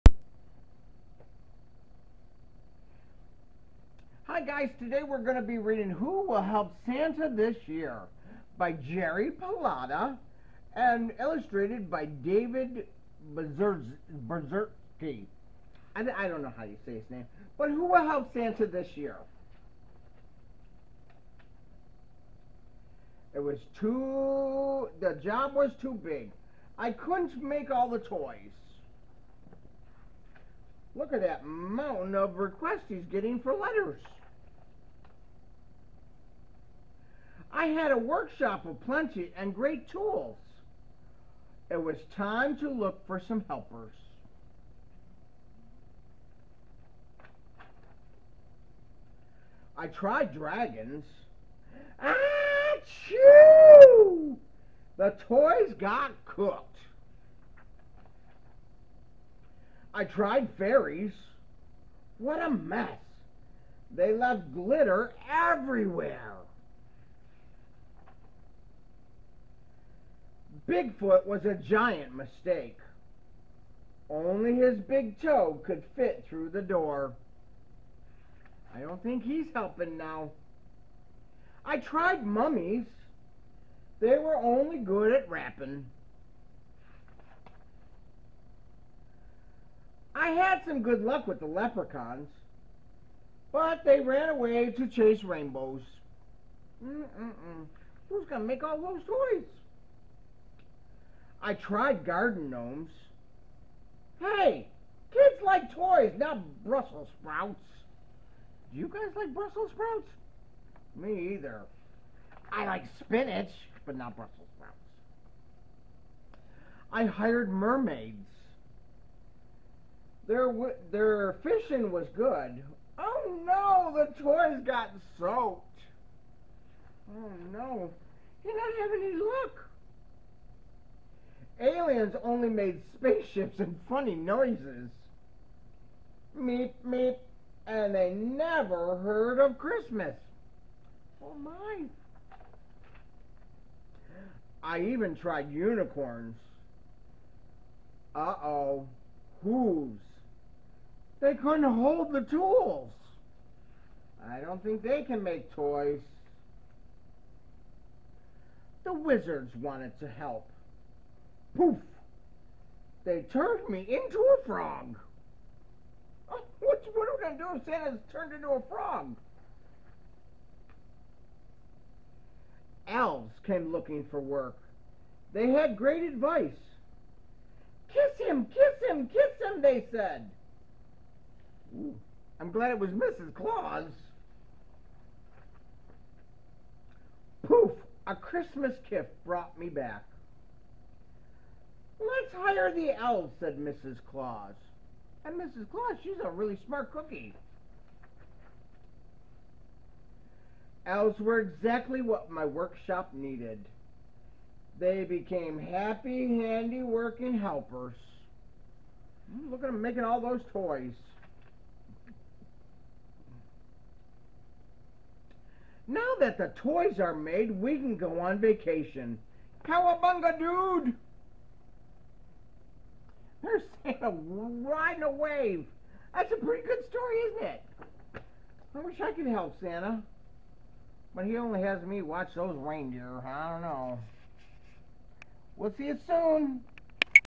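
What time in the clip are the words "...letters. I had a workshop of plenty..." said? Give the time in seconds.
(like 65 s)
33 s.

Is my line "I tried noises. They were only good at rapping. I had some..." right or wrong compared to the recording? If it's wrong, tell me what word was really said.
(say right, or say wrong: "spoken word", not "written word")
wrong: "mummies", not "noises".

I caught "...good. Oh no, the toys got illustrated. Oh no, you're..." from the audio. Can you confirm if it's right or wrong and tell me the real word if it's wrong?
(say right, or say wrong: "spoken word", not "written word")
wrong: "soaked", not "illustrated".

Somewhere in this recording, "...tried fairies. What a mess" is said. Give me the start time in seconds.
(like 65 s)
60 s.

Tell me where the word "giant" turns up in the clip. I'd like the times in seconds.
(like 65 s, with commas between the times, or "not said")
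71 s.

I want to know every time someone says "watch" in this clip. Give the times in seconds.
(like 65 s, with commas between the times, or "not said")
232 s.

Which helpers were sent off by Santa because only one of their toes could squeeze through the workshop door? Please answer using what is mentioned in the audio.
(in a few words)
Bigfoot.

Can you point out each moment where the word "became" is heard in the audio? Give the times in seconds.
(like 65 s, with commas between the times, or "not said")
205 s.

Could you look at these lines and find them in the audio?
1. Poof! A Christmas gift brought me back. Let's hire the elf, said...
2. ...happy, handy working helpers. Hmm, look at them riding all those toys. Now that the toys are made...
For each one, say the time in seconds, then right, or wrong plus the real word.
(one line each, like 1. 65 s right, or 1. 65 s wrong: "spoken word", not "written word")
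1. 187 s right
2. 205 s wrong: "making", not "riding".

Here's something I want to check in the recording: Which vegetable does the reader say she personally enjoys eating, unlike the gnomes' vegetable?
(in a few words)
Spinach.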